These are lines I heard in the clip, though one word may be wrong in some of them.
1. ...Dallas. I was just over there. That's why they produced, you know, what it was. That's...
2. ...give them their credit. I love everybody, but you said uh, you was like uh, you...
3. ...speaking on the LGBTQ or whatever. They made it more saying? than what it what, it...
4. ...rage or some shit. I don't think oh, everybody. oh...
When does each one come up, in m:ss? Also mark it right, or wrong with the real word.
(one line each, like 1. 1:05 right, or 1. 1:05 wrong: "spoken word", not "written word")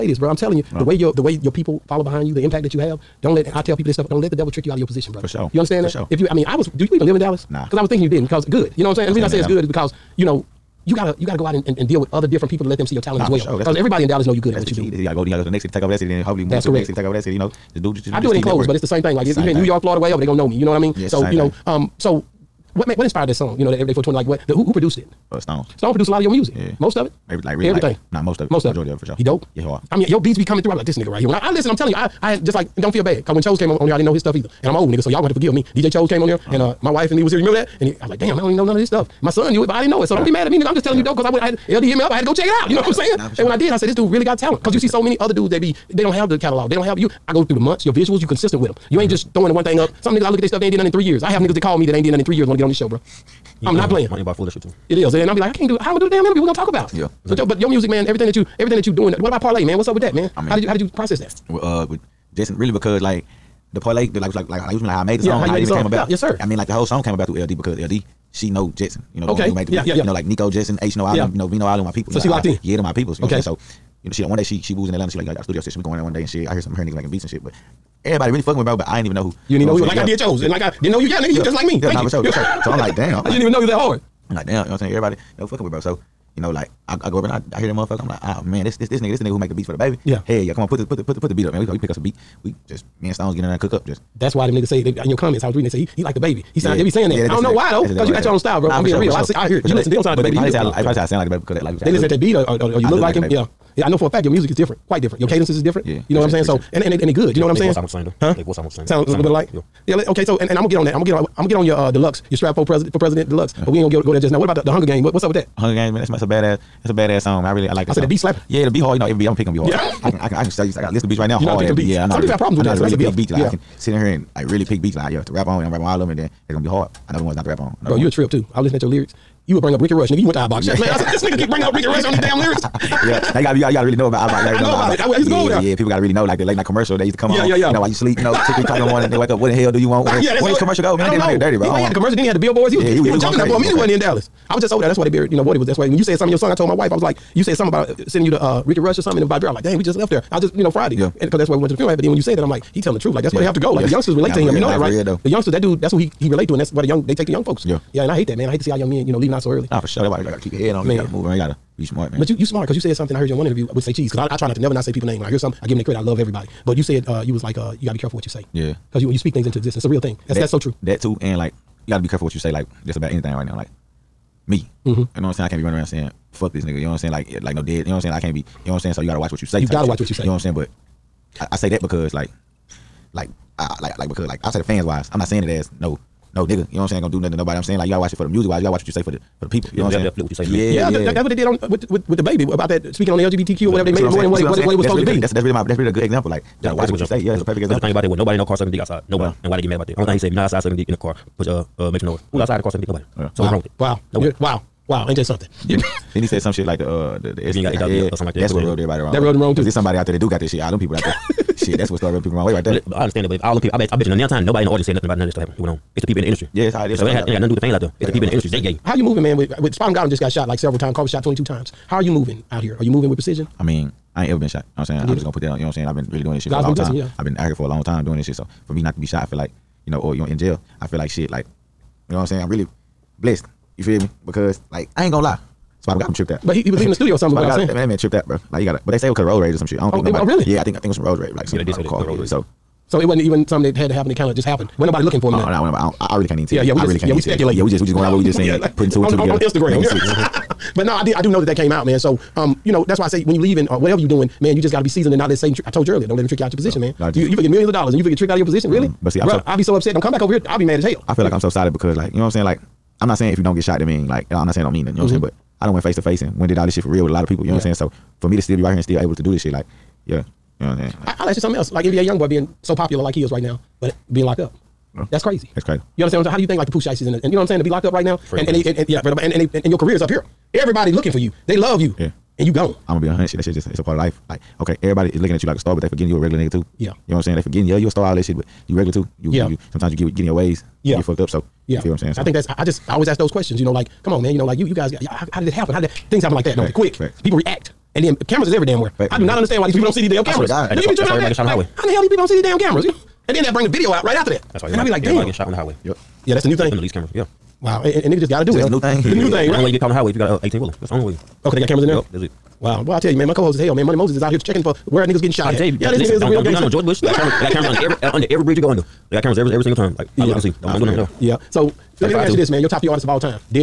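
1. 2:23 wrong: "buried", not "produced"
2. 2:45 right
3. 3:12 right
4. 3:59 wrong: "nobody", not "everybody".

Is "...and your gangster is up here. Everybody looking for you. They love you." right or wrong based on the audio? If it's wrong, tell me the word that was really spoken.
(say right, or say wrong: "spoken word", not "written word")
wrong: "career", not "gangster".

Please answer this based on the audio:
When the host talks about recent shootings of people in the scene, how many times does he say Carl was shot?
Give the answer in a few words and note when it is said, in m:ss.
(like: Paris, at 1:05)
22, at 3:41.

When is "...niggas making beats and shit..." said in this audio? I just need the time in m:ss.
1:16.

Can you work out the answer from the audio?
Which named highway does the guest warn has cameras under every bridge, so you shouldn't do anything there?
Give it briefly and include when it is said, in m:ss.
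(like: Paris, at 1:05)
George Bush, at 5:16.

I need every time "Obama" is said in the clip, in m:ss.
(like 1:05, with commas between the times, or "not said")
not said.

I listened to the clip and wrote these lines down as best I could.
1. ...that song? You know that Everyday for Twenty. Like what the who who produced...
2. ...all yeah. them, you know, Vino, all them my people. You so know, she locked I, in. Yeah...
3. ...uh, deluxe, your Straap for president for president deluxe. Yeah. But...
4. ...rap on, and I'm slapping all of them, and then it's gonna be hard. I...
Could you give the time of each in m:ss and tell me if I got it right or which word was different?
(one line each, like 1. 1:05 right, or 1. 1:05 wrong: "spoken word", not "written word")
1. 0:23 right
2. 1:11 right
3. 1:51 right
4. 2:05 wrong: "rapping", not "slapping".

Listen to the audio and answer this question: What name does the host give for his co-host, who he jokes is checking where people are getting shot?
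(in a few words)
Money Moses.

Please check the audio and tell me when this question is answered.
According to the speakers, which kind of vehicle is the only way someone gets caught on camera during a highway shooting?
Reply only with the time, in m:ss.
5:10.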